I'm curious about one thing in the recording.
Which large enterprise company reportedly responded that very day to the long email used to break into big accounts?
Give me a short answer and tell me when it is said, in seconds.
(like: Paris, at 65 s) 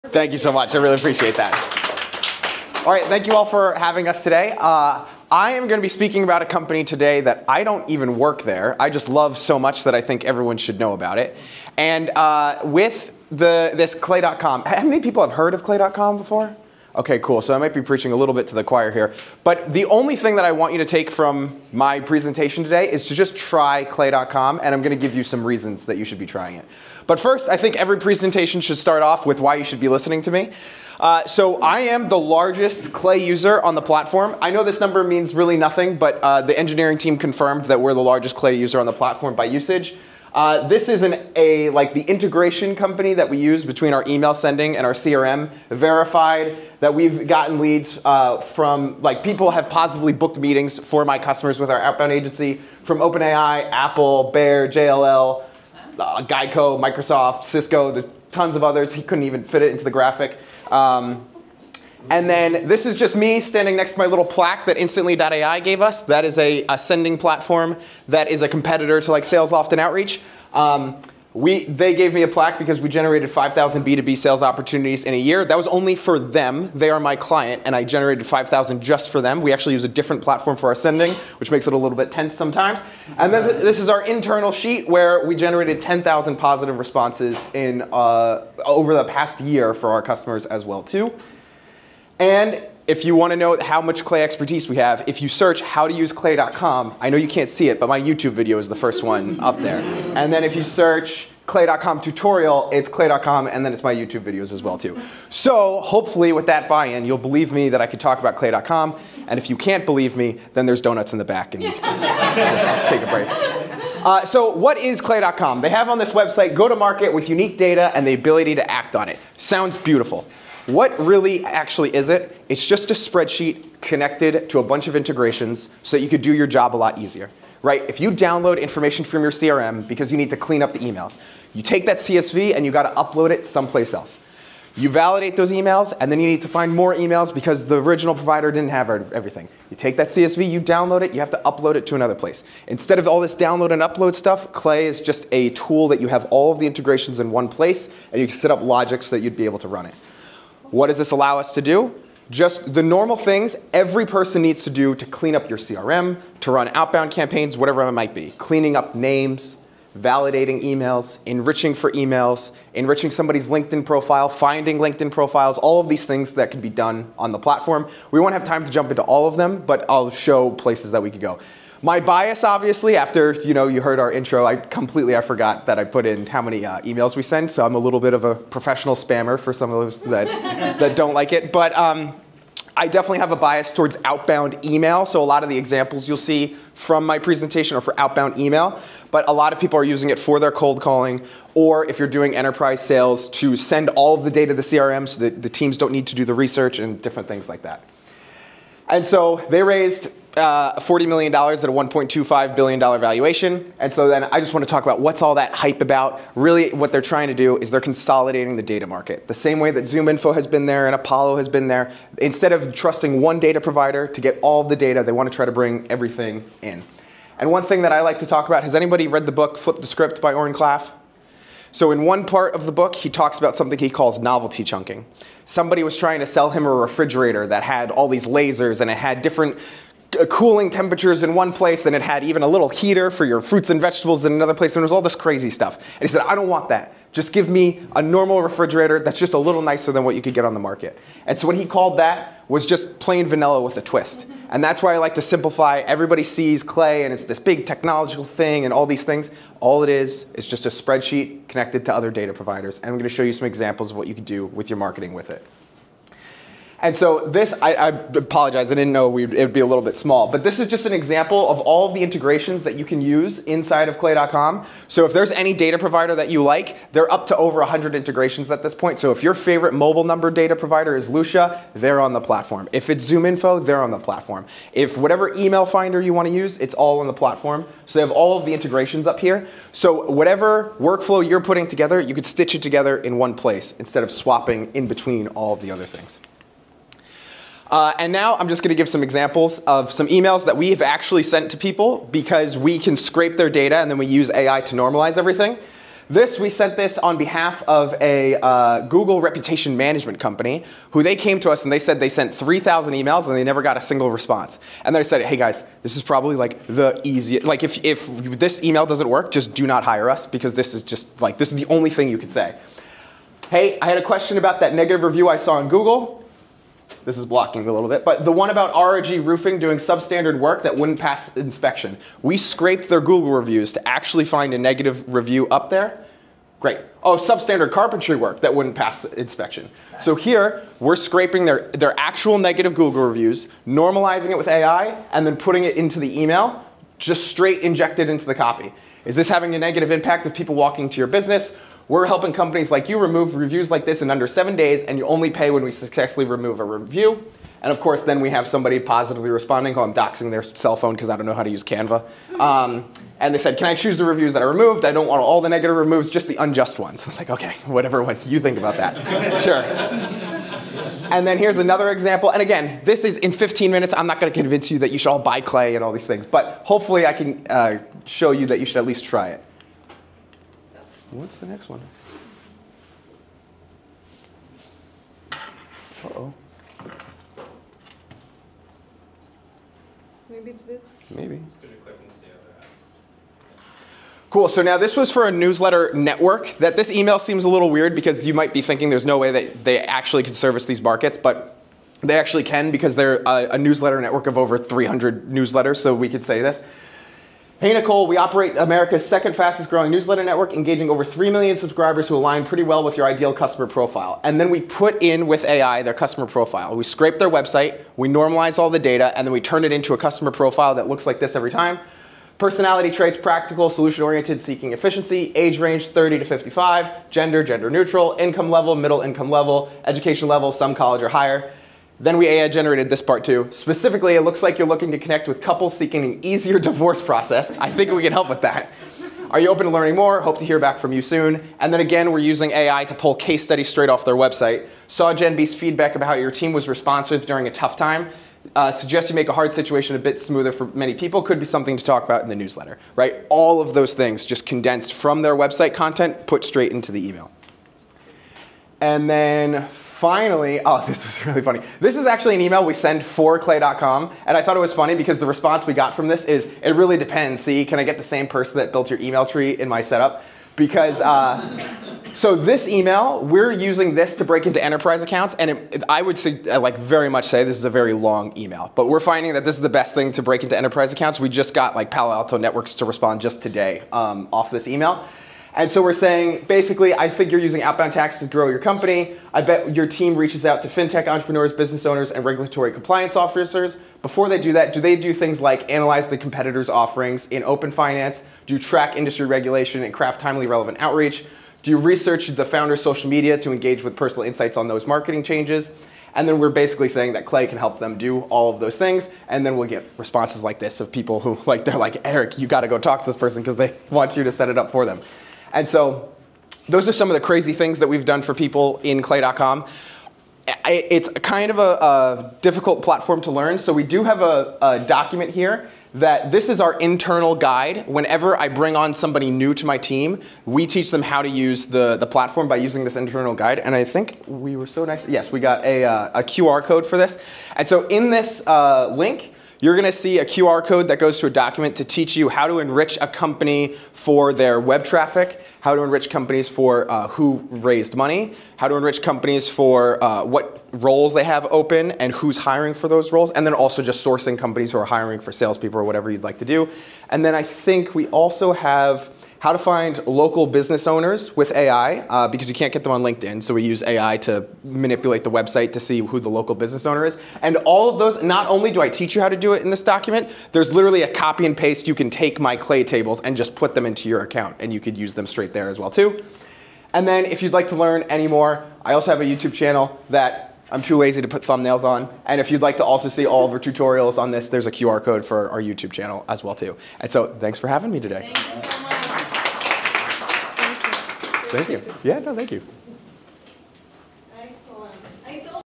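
Palo Alto Networks, at 471 s.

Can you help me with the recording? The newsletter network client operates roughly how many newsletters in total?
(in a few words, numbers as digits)
over 300.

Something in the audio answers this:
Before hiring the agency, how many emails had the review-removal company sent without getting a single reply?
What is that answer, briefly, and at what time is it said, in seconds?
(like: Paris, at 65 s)
3,000, at 302 s.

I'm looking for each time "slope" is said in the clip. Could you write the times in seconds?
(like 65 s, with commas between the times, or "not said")
not said.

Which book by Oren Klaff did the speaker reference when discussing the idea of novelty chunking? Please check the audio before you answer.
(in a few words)
Flip the Script.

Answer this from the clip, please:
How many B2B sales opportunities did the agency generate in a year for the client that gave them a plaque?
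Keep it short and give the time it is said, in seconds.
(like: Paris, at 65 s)
5,000, at 73 s.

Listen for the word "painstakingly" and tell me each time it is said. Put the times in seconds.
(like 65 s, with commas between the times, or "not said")
not said.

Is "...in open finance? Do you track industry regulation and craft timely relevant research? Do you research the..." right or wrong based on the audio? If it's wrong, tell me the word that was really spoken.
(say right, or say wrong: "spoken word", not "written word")
wrong: "outreach", not "research".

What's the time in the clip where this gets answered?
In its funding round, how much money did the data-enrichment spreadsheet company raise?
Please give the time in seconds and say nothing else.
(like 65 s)
200 s.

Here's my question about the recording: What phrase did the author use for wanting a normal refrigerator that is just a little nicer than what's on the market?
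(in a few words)
plain vanilla with a twist.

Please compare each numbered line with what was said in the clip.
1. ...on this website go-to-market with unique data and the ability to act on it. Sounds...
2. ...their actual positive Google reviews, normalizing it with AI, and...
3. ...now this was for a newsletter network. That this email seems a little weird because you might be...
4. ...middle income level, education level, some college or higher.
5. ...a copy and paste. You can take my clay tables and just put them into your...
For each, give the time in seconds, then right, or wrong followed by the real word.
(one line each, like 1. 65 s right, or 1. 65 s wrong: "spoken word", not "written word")
1. 115 s right
2. 331 s wrong: "negative", not "positive"
3. 384 s right
4. 418 s right
5. 561 s right.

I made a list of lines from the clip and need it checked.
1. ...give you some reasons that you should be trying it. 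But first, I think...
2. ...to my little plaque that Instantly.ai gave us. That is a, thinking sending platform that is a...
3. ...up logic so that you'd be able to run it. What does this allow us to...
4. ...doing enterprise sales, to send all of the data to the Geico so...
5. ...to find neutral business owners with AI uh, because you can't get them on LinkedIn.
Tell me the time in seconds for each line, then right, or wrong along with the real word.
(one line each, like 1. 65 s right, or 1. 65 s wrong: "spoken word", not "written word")
1. 25 s right
2. 63 s wrong: "ascending", not "thinking"
3. 148 s right
4. 192 s wrong: "CRM", not "Geico"
5. 549 s wrong: "local", not "neutral".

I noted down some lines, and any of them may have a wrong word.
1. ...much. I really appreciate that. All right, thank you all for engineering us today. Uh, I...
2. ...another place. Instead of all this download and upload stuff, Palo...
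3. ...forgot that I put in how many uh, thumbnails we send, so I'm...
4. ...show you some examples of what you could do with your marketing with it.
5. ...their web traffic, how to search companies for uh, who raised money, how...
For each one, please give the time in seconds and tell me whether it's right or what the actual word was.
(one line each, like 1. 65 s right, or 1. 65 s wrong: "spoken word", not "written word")
1. 0 s wrong: "having", not "engineering"
2. 141 s wrong: "Clay", not "Palo"
3. 175 s wrong: "emails", not "thumbnails"
4. 253 s right
5. 534 s wrong: "enrich", not "search".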